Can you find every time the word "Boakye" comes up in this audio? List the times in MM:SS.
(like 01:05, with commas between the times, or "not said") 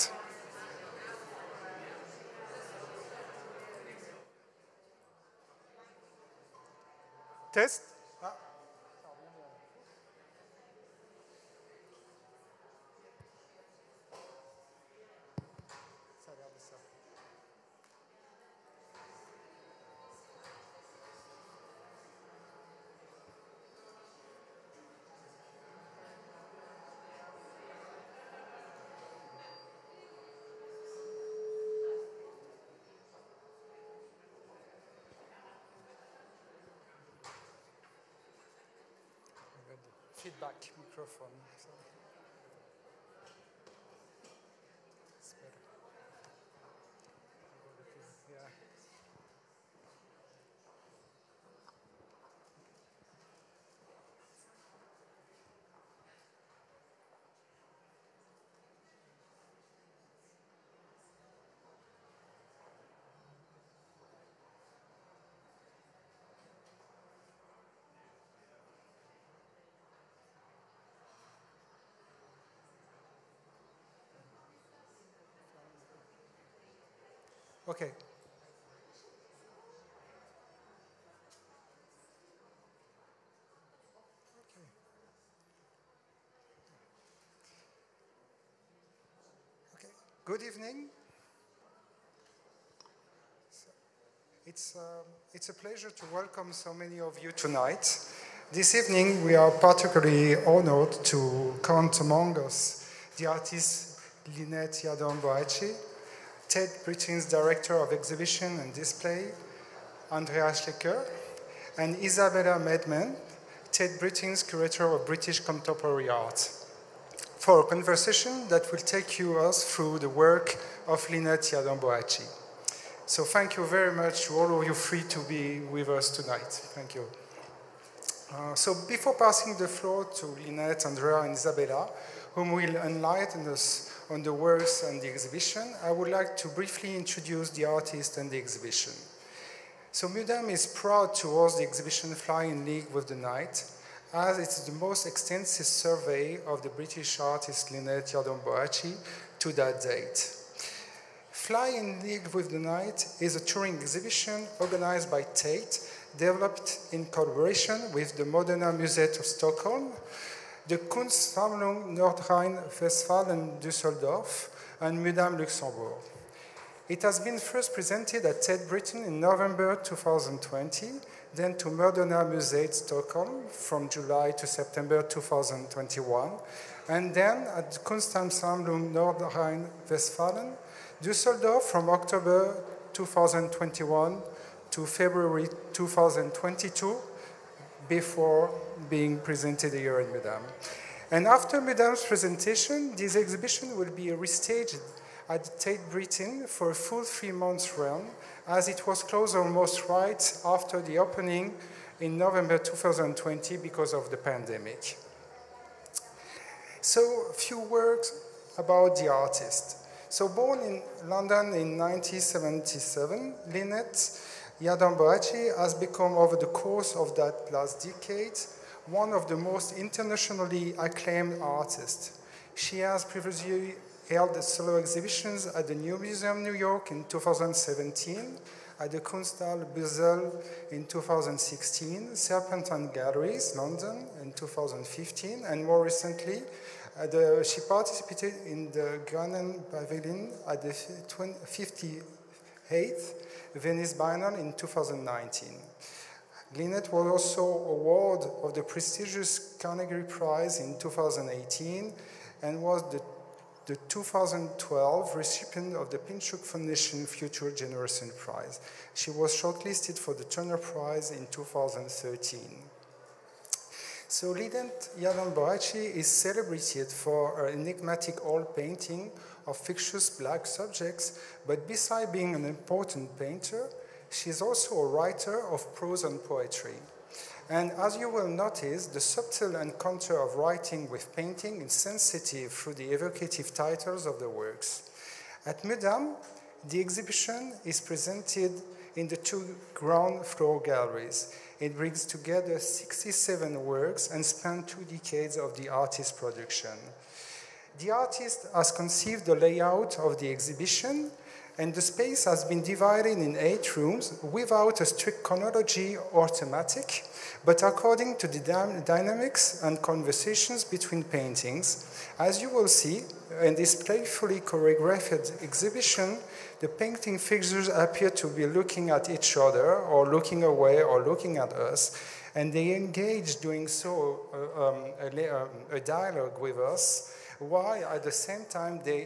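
01:44, 02:01, 02:28, 03:34, 04:24.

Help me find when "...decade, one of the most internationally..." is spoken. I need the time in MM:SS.
03:37.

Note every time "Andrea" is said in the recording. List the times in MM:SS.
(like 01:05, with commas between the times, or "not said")
01:50, 02:10.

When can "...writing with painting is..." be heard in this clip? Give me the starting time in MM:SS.
04:40.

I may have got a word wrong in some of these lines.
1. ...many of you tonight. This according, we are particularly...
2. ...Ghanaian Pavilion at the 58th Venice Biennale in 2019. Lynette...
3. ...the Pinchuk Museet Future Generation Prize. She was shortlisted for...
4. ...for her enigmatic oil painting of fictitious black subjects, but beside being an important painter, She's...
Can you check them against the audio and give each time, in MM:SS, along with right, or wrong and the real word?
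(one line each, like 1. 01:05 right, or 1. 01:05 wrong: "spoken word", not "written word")
1. 01:36 wrong: "evening", not "according"
2. 03:59 right
3. 04:15 wrong: "Foundation", not "Museet"
4. 04:26 right.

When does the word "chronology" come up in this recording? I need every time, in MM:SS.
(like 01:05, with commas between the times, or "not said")
05:05.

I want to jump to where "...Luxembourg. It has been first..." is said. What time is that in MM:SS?
02:45.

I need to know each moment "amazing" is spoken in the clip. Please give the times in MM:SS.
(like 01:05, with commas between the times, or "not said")
not said.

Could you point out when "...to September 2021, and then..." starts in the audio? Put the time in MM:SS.
02:54.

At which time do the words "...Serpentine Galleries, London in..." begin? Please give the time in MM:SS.
03:52.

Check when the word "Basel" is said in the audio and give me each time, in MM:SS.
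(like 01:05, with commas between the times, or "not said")
03:49.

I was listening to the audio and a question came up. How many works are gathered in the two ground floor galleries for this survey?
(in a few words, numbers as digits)
67.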